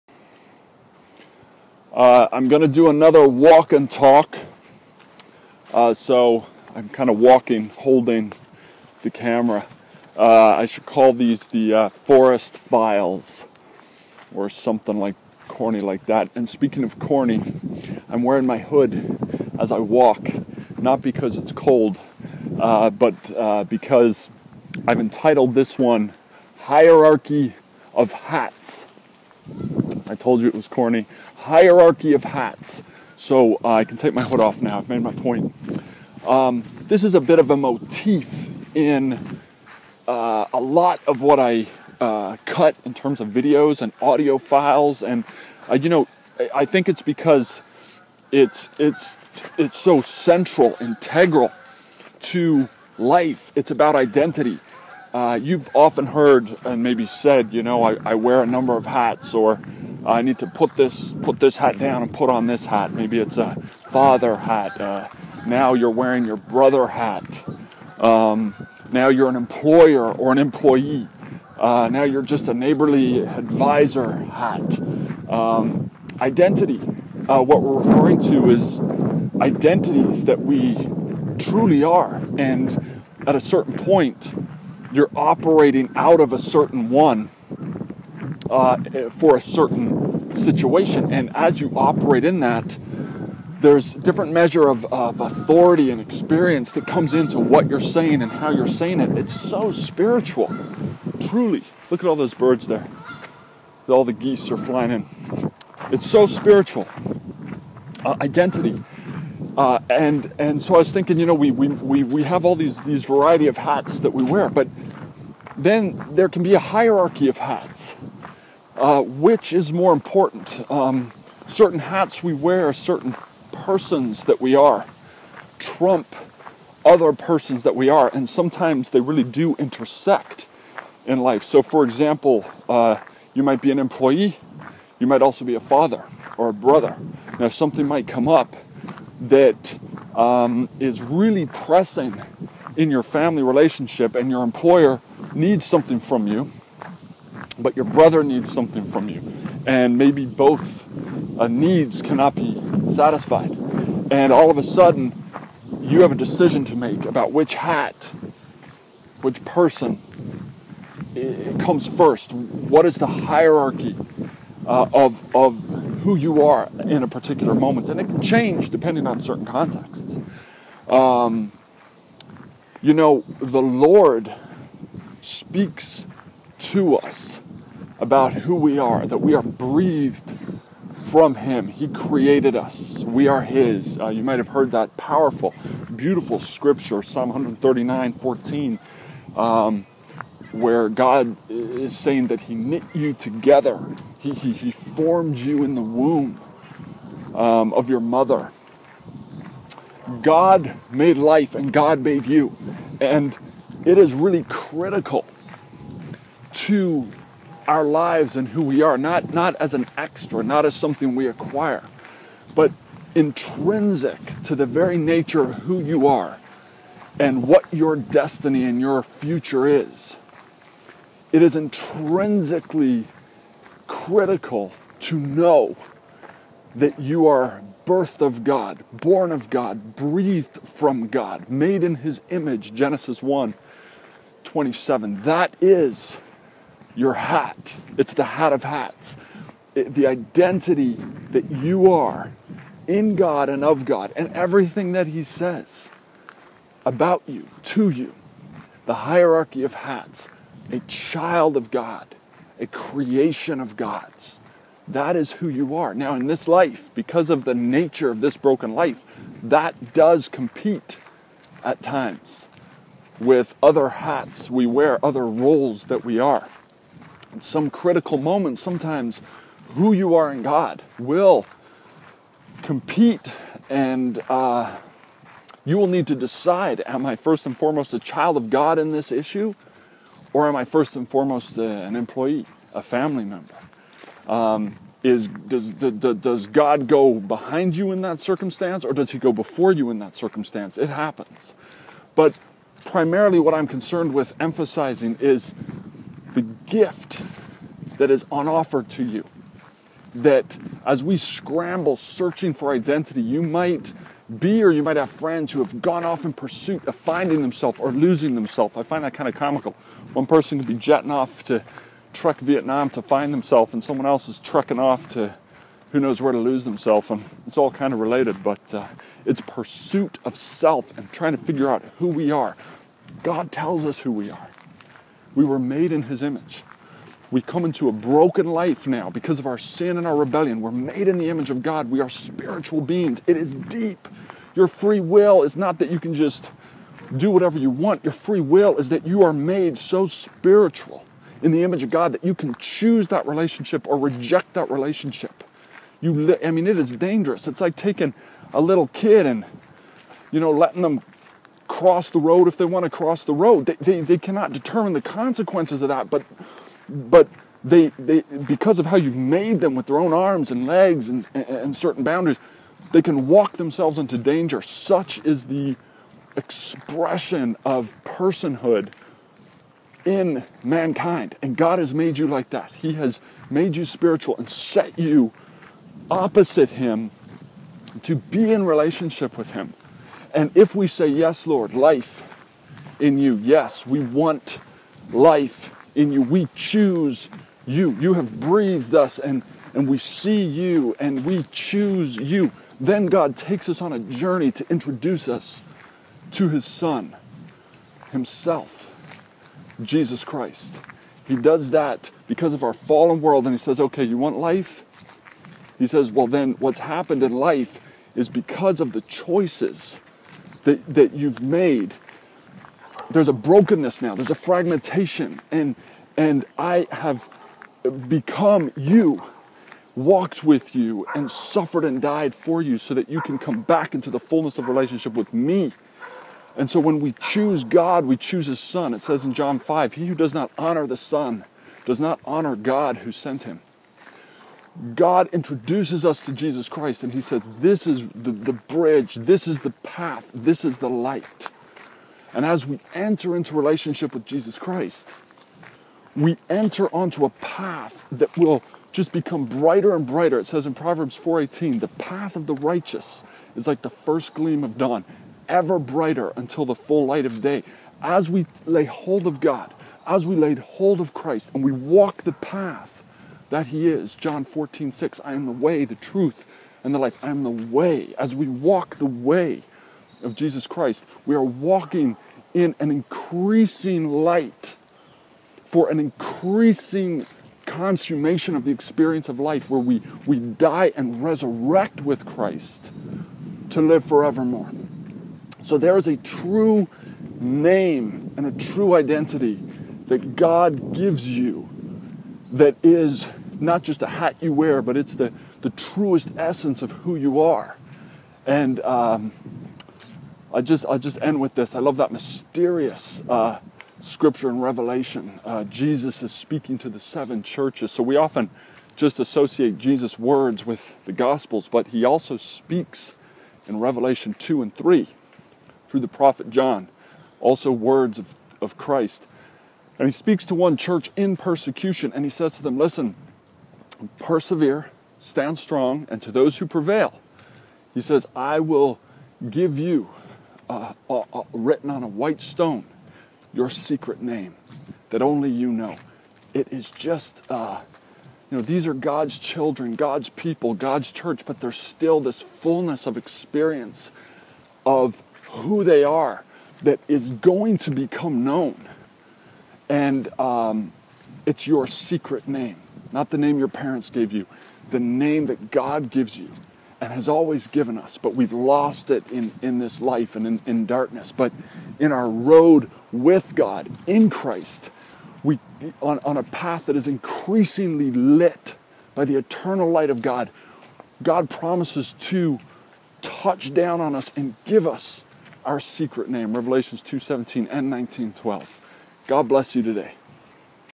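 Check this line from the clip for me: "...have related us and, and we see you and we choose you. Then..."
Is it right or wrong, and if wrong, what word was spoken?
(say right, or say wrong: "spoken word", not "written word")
wrong: "breathed", not "related".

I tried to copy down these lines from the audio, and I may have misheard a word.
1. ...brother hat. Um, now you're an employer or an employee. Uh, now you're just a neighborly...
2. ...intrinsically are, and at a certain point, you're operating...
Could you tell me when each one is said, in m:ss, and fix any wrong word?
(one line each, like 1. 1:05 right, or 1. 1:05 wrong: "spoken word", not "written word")
1. 1:06 right
2. 1:21 wrong: "truly", not "intrinsically".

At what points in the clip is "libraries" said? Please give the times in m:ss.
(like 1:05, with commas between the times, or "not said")
not said.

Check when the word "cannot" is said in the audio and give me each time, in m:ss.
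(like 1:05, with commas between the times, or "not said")
2:32, 5:54.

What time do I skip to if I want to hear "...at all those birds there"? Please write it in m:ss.
1:42.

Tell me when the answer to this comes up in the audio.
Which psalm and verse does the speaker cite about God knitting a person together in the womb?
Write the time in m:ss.
3:07.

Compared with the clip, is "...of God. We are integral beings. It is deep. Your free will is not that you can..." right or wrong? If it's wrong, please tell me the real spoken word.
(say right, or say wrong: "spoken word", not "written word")
wrong: "spiritual", not "integral".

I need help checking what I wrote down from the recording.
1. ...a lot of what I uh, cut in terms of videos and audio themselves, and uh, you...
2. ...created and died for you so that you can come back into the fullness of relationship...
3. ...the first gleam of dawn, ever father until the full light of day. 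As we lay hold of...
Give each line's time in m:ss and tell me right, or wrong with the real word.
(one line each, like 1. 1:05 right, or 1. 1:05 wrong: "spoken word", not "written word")
1. 0:40 wrong: "files", not "themselves"
2. 7:01 wrong: "suffered", not "created"
3. 7:33 wrong: "brighter", not "father".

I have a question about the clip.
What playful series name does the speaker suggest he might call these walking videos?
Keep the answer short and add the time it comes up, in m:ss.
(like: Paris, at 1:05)
Forest Files, at 0:11.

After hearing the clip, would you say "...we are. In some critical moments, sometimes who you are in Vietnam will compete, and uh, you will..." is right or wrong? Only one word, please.
wrong.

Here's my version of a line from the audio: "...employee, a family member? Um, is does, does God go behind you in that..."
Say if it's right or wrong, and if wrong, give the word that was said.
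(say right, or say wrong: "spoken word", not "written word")
right.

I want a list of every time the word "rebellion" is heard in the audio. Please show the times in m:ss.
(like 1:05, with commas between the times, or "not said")
5:30.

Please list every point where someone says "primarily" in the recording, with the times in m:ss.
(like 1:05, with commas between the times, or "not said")
4:52.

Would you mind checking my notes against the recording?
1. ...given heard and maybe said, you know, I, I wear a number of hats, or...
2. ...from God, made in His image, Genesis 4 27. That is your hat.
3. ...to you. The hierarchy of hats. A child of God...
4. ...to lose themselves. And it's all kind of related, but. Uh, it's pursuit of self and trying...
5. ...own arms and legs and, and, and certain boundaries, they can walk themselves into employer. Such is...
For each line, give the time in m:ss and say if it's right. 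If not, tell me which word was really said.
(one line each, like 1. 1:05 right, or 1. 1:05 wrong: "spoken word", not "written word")
1. 0:55 wrong: "often", not "given"
2. 3:50 wrong: "1", not "4"
3. 4:07 right
4. 5:16 right
5. 5:59 wrong: "danger", not "employer".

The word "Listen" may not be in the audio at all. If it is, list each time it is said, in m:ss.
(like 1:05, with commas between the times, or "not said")
8:42.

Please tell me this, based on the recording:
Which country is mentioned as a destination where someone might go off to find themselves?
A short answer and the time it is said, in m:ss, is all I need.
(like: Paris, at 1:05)
Vietnam, at 5:12.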